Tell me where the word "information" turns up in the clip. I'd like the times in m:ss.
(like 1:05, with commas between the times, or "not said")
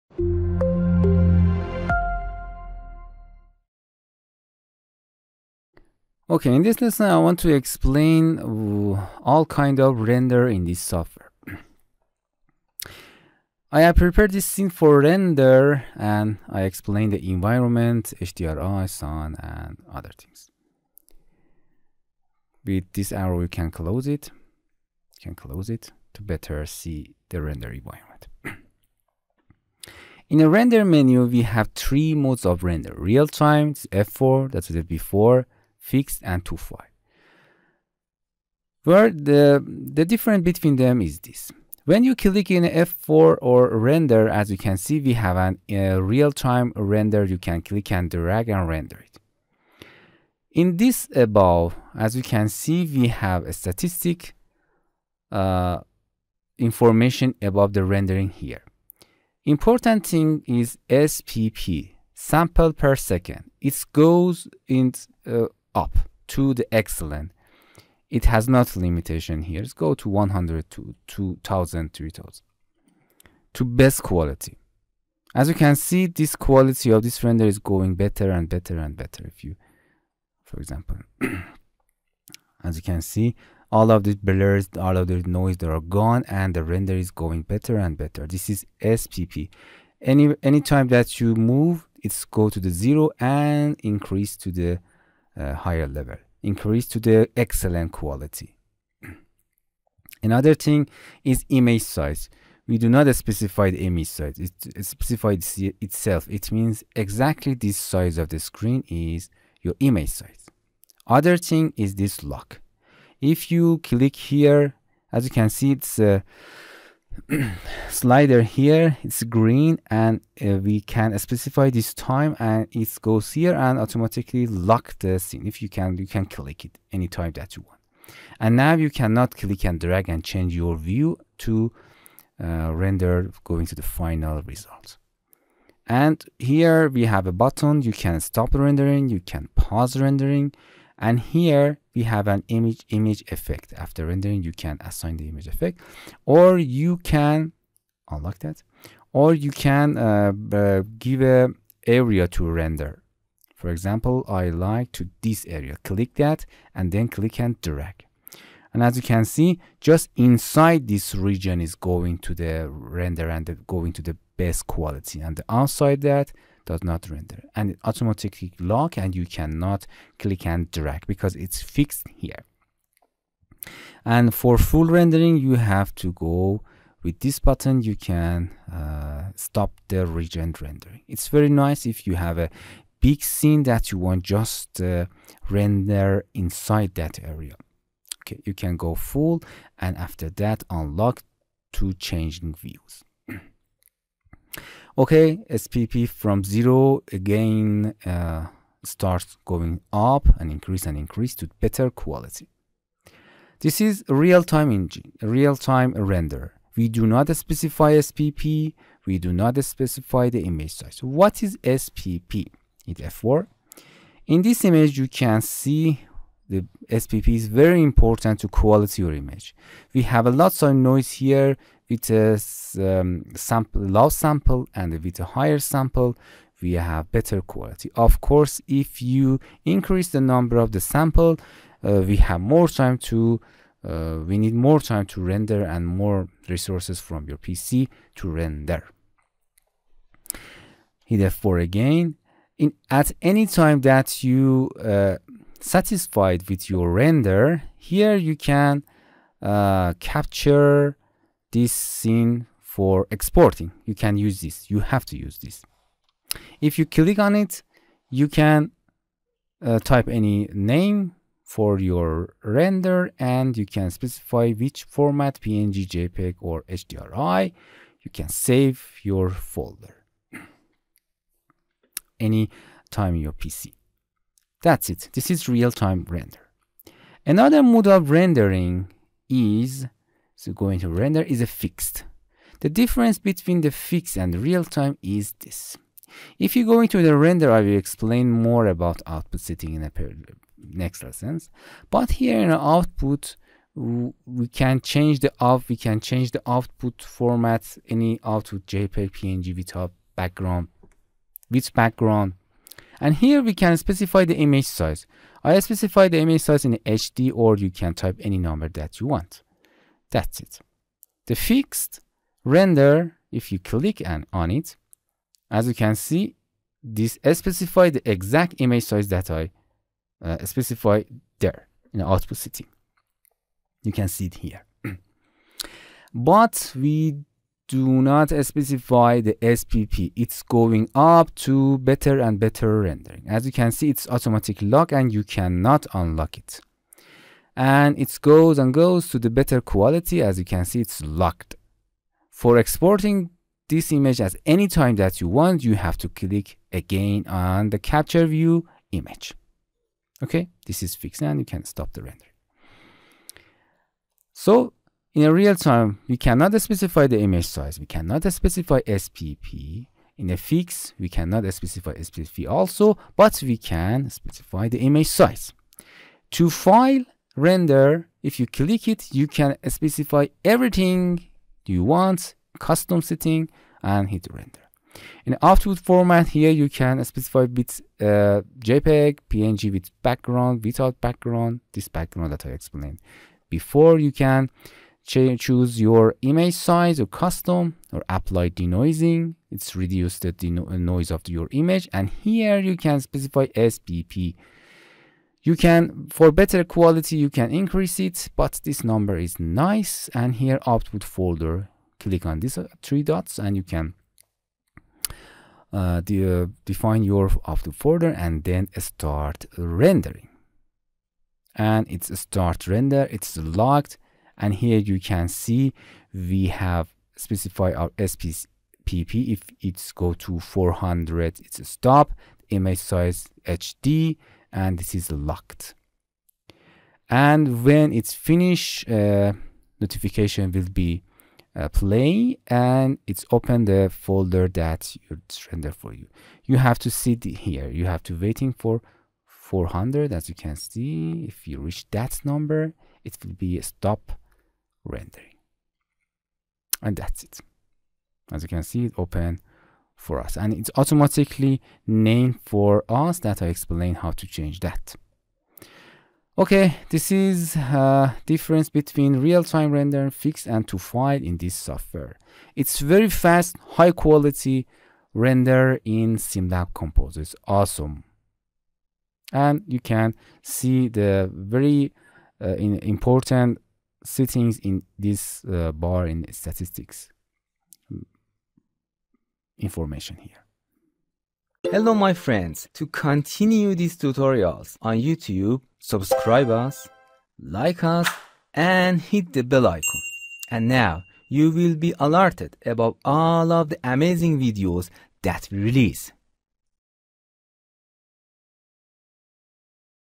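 0:56, 7:59.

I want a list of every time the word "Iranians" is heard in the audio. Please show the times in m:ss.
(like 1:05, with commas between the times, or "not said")
not said.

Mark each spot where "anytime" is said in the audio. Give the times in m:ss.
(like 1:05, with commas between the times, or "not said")
2:06.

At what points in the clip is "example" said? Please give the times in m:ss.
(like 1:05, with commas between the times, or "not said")
1:20, 2:33.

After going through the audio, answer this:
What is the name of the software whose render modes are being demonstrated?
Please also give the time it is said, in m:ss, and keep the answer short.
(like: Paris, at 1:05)
SimLab Composer, at 7:46.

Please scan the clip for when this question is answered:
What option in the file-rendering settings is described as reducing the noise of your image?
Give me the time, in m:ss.
6:28.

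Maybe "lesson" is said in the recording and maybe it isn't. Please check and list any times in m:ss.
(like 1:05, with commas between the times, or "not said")
0:06, 4:51.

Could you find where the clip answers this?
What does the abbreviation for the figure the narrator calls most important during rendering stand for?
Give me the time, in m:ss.
1:02.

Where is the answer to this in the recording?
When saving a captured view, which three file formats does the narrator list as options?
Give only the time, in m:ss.
4:25.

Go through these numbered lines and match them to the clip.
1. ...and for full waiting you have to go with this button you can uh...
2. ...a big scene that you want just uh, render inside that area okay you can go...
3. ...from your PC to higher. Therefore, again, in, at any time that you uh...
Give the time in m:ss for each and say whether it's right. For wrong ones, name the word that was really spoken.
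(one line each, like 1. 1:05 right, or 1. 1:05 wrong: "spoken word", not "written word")
1. 2:54 wrong: "rendering", not "waiting"
2. 3:02 right
3. 3:57 wrong: "render", not "higher".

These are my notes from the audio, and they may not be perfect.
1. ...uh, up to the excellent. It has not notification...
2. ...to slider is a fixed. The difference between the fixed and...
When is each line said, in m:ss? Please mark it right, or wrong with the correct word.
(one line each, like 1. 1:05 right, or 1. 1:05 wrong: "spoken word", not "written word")
1. 1:05 wrong: "limitation", not "notification"
2. 4:40 wrong: "render", not "slider".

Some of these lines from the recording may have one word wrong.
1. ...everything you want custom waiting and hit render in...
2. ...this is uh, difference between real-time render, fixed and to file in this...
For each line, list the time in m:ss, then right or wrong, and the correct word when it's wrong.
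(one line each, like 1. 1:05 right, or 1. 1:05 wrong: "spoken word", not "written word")
1. 6:10 wrong: "setting", not "waiting"
2. 7:36 right.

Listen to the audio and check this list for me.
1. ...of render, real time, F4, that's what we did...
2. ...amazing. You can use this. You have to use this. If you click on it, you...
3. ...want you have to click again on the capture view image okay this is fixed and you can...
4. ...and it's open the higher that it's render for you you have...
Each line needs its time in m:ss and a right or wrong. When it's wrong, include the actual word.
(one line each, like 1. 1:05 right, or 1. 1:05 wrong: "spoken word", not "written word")
1. 0:32 right
2. 4:13 wrong: "exporting", not "amazing"
3. 5:45 right
4. 7:12 wrong: "folder", not "higher".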